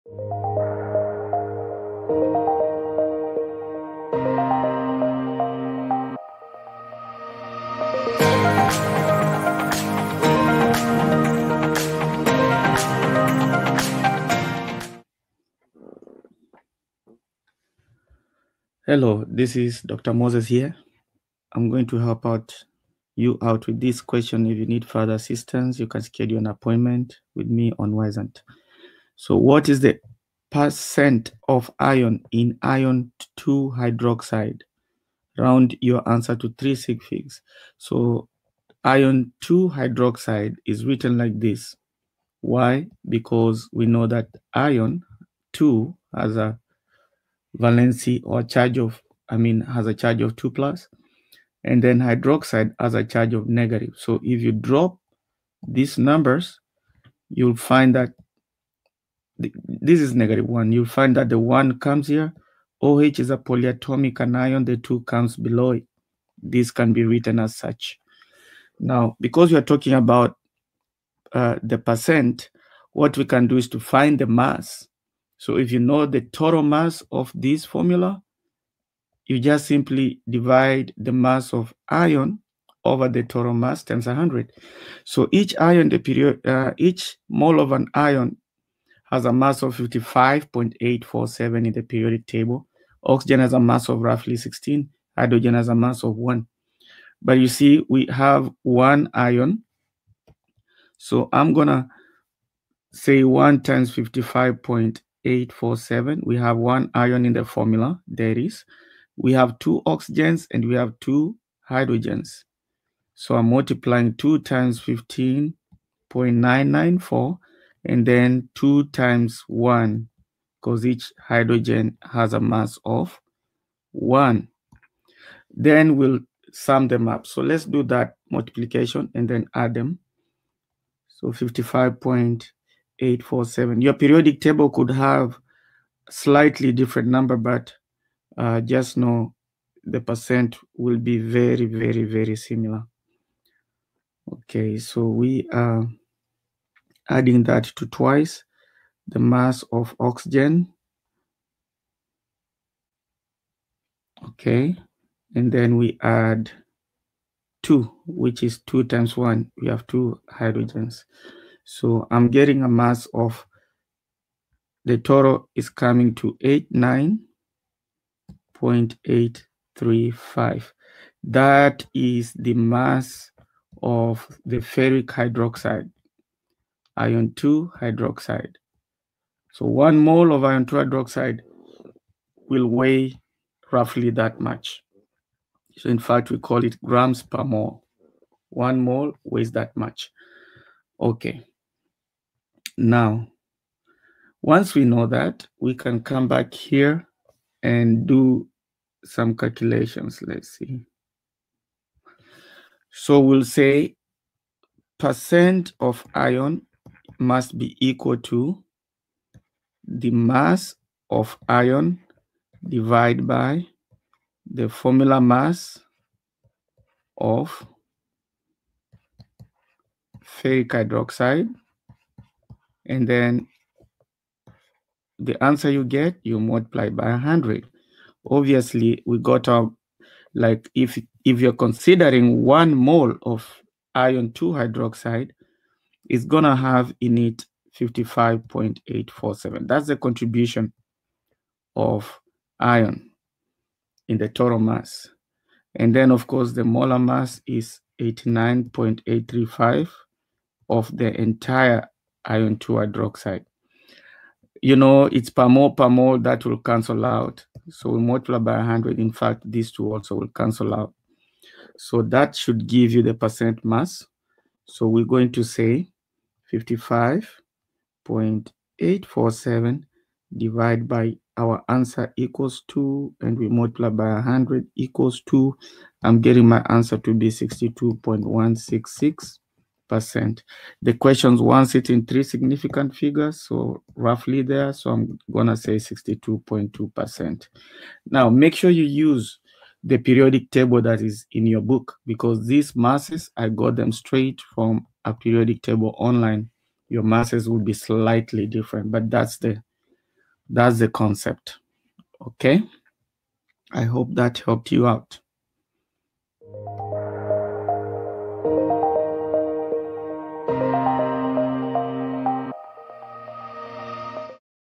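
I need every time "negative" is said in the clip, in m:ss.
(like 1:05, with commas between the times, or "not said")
0:53, 1:00.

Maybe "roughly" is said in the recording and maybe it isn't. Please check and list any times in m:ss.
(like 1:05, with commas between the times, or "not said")
1:34, 3:03, 4:43.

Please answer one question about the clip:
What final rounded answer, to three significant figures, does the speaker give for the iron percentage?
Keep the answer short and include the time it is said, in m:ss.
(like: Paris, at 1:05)
62.2%, at 4:45.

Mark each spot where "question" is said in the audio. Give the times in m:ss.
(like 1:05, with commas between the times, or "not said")
0:24, 4:40.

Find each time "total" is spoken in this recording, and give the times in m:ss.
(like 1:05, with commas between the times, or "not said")
1:16, 1:23, 2:44, 4:04.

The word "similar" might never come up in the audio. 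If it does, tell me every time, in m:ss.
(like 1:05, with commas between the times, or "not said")
2:22.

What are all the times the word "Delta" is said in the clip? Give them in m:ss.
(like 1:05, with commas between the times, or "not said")
not said.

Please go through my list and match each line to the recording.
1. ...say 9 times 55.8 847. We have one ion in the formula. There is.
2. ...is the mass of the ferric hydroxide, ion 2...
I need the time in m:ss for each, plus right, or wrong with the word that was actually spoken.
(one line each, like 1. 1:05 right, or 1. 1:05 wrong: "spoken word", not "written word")
1. 1:42 wrong: "1", not "9"
2. 2:51 right.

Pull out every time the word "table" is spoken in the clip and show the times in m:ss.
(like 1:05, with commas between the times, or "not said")
1:32, 2:14, 4:50, 4:55.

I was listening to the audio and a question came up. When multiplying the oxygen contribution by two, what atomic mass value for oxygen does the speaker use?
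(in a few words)
15.994.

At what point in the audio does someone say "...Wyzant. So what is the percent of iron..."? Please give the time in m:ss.
0:27.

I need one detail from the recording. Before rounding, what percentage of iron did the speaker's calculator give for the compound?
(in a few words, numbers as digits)
62.166 percent.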